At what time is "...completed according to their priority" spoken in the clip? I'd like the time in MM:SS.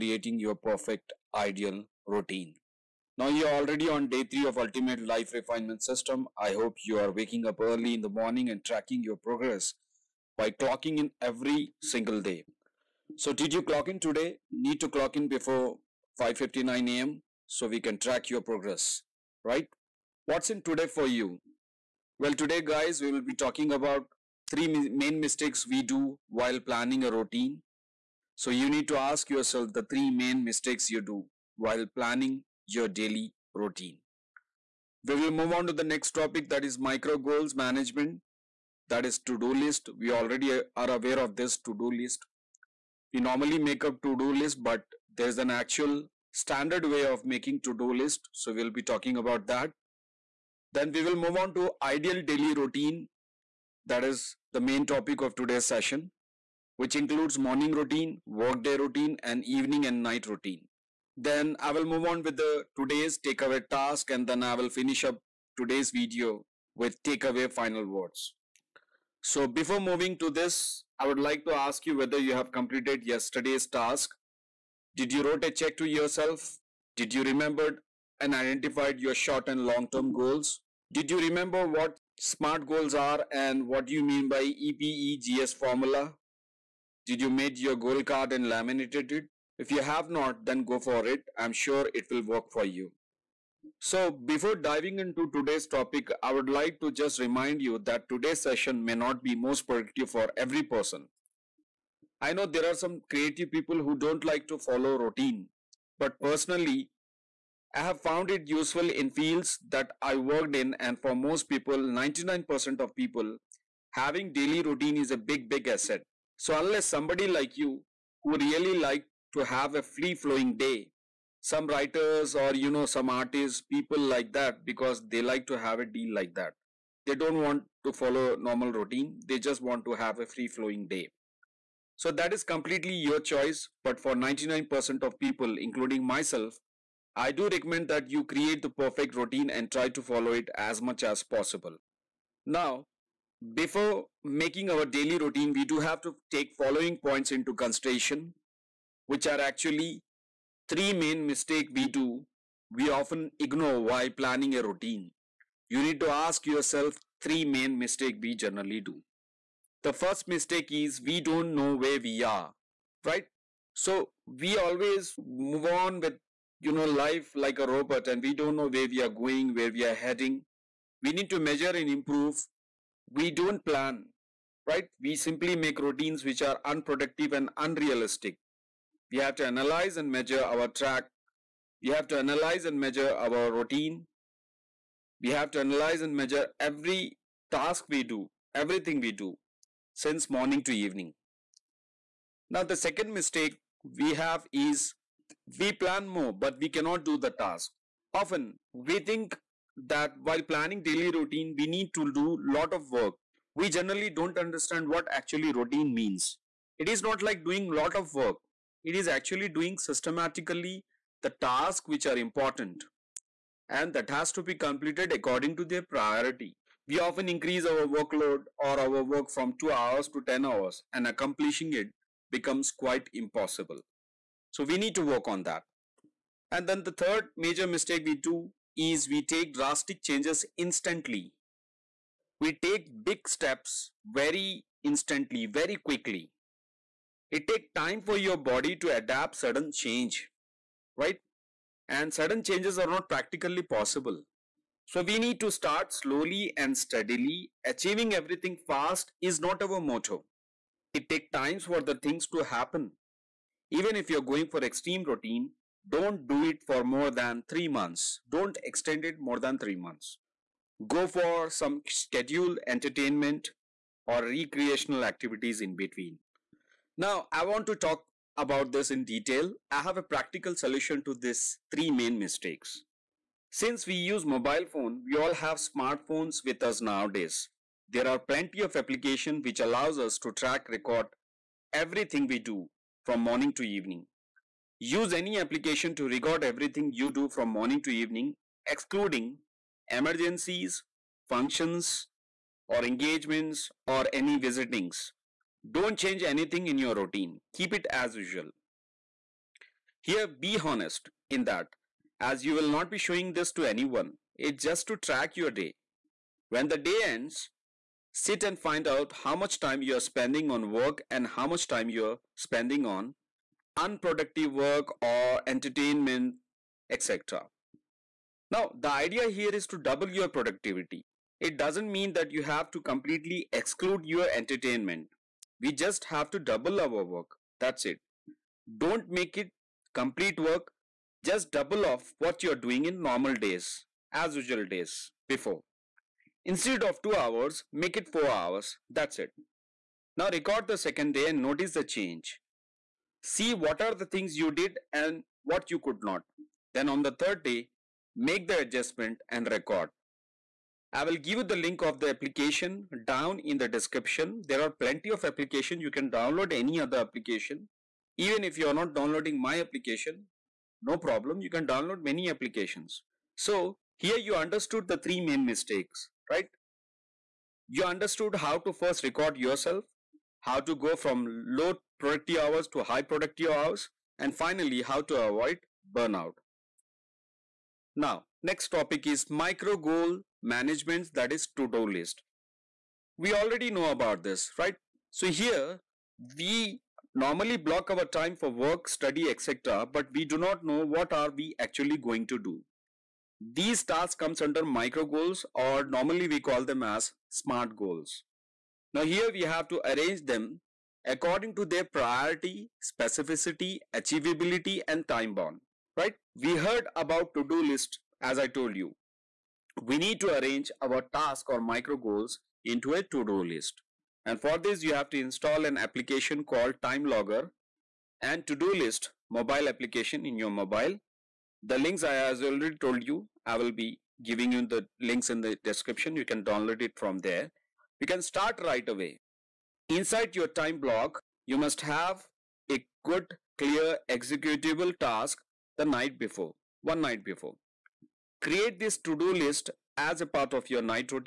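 03:34.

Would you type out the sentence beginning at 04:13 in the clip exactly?
Even if you're going for extreme routine, don't do it for more than 3 months.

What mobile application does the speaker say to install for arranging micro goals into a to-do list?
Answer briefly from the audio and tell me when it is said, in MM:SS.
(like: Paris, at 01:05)
Time Logger, at 06:56.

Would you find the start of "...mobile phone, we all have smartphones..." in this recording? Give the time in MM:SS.
04:34.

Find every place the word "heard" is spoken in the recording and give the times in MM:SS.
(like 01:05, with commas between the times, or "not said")
06:46.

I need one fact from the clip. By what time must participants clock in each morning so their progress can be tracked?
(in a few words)
5:59 a.m.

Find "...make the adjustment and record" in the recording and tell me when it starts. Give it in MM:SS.
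05:48.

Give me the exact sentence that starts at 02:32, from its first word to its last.
We often ignore while planning a routine.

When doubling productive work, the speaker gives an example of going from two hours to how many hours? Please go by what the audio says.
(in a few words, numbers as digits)
4 hours.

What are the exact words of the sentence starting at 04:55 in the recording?
Don't change anything in your routine.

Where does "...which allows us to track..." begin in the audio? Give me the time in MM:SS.
04:39.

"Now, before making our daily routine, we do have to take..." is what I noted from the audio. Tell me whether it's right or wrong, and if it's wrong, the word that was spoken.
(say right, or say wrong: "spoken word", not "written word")
right.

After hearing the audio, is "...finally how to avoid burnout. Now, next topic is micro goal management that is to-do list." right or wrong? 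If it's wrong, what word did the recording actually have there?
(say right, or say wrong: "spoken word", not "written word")
right.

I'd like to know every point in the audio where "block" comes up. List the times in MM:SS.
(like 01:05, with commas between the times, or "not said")
06:27, 07:10.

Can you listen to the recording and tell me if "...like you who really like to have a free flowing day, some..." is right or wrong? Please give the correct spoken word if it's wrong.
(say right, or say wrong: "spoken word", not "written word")
right.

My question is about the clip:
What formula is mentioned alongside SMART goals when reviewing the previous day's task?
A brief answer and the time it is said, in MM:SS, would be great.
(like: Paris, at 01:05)
EPEGS formula, at 01:24.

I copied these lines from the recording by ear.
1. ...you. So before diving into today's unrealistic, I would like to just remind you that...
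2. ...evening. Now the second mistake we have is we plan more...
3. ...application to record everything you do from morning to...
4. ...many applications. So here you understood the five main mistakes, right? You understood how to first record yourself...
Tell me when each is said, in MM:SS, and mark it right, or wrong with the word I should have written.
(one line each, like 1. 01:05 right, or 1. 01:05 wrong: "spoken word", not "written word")
1. 01:32 wrong: "topic", not "unrealistic"
2. 03:10 right
3. 04:45 right
4. 06:02 wrong: "three", not "five".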